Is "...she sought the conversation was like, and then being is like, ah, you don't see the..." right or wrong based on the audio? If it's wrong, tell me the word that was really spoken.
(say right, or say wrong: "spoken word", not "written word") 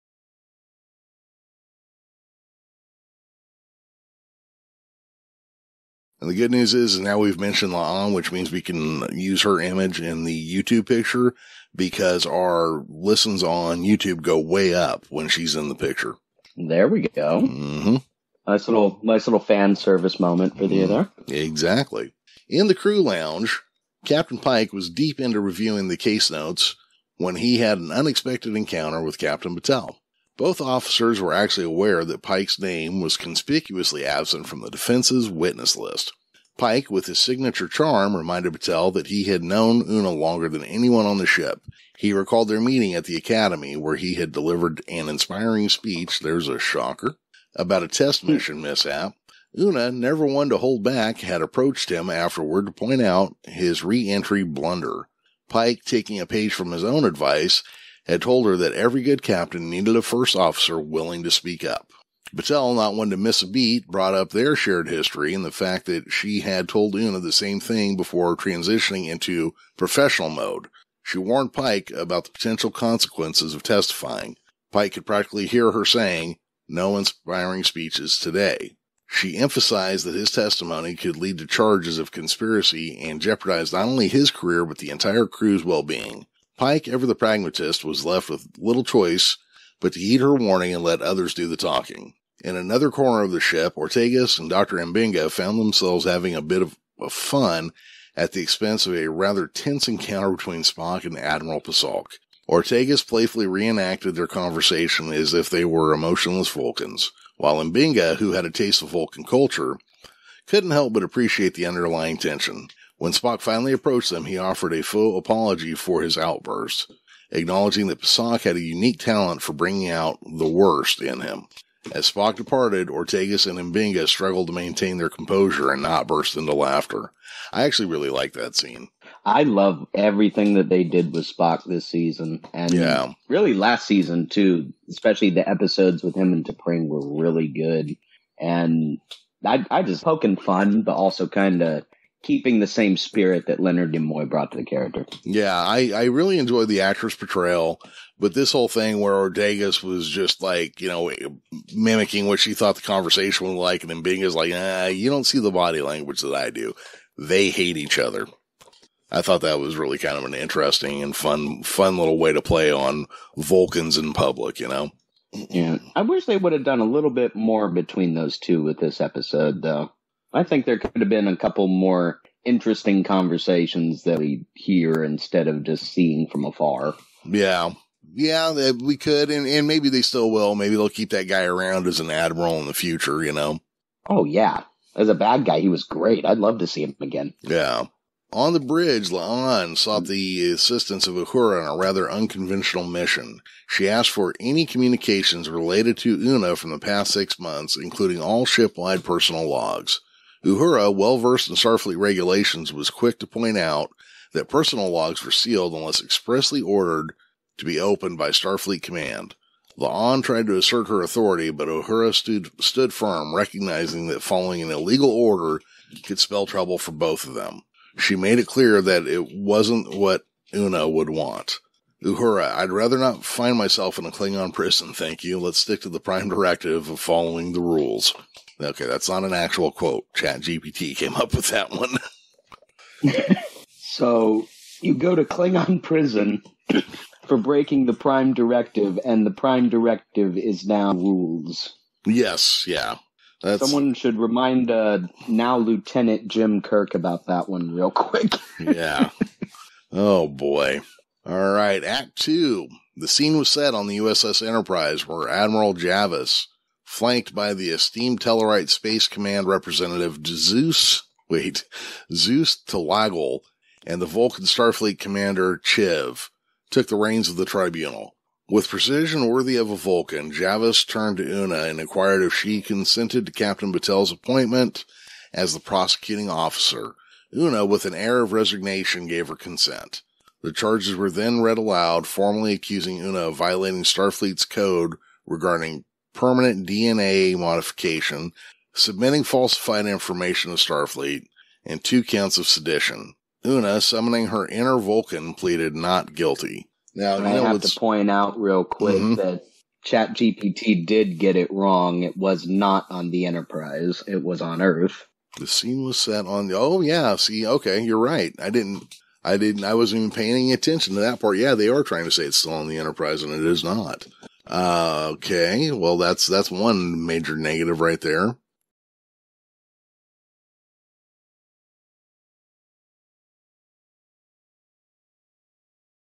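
wrong: "thought", not "sought".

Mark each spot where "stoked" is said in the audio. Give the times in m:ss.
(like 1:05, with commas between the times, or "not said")
not said.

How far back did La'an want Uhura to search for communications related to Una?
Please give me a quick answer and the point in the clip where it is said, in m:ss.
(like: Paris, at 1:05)
Six months, at 3:17.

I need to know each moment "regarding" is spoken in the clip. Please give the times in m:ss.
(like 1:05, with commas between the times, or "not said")
4:45.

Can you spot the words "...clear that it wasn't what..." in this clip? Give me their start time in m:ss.
3:38.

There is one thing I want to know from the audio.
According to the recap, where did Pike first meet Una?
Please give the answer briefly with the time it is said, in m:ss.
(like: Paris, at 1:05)
The academy, at 0:43.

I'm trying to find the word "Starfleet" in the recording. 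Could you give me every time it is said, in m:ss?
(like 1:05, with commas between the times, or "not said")
3:21, 3:28, 4:24, 4:43, 4:50.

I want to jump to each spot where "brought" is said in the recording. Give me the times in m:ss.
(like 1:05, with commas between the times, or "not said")
1:03, 2:24.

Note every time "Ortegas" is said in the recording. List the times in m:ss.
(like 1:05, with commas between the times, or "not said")
1:33, 1:42, 2:02, 2:29.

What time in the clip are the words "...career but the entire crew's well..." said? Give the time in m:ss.
1:24.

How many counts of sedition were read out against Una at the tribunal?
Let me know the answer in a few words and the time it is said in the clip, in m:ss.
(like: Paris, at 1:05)
2, at 4:51.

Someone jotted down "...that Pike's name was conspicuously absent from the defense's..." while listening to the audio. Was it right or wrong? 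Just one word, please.
right.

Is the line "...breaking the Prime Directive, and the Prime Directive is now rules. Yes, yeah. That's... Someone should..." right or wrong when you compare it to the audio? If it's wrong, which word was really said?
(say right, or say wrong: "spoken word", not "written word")
right.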